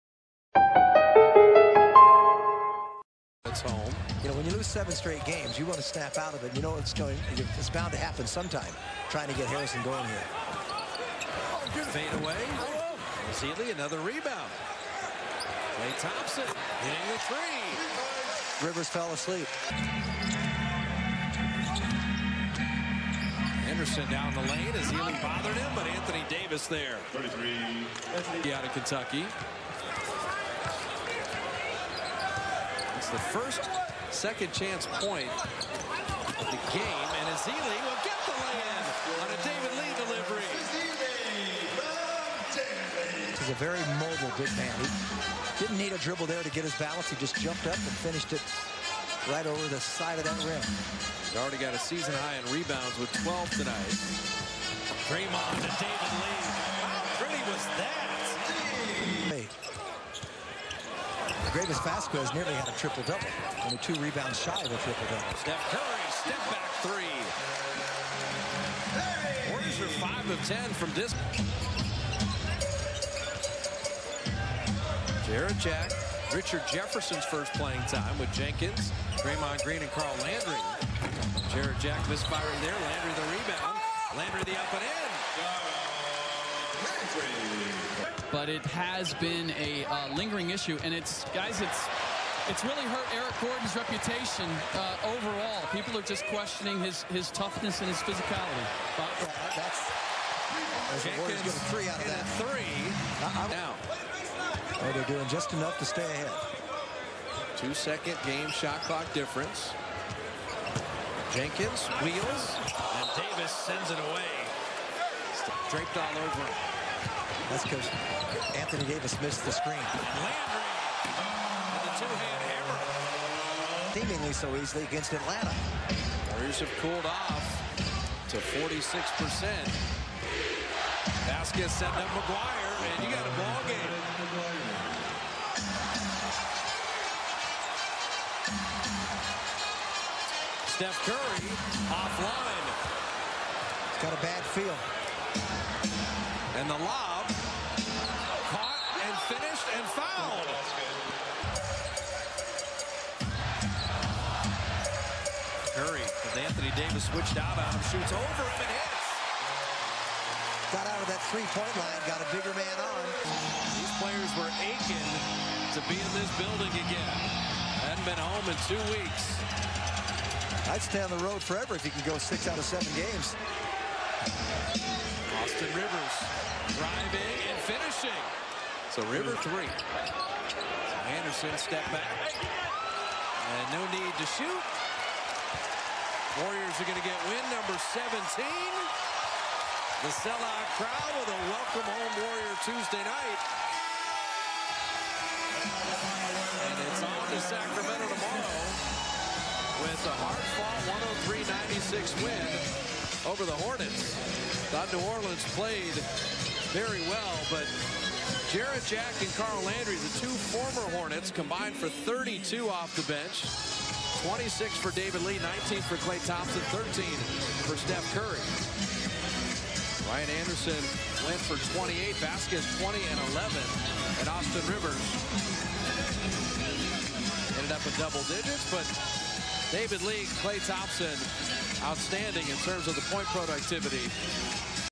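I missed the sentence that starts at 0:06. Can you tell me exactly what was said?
You know it's going, it's bound to happen sometime, trying to get Harrison going here.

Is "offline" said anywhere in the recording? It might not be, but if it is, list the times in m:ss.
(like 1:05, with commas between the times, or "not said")
2:21.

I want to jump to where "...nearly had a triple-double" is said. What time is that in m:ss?
1:02.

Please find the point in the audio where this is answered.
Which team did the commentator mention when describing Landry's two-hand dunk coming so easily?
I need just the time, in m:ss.
2:05.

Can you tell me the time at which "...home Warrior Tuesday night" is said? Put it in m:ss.
3:11.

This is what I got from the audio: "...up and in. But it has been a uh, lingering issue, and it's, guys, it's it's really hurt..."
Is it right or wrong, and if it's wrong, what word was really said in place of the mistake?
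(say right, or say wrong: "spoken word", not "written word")
right.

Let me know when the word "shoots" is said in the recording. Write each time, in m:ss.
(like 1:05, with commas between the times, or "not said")
2:37, 3:04.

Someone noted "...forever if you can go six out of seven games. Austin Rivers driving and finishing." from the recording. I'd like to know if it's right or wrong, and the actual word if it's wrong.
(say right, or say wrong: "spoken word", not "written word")
right.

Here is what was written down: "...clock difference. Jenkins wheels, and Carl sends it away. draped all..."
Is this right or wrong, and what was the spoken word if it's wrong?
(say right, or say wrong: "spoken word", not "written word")
wrong: "Davis", not "Carl".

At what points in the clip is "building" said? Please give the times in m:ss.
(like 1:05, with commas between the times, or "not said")
2:46.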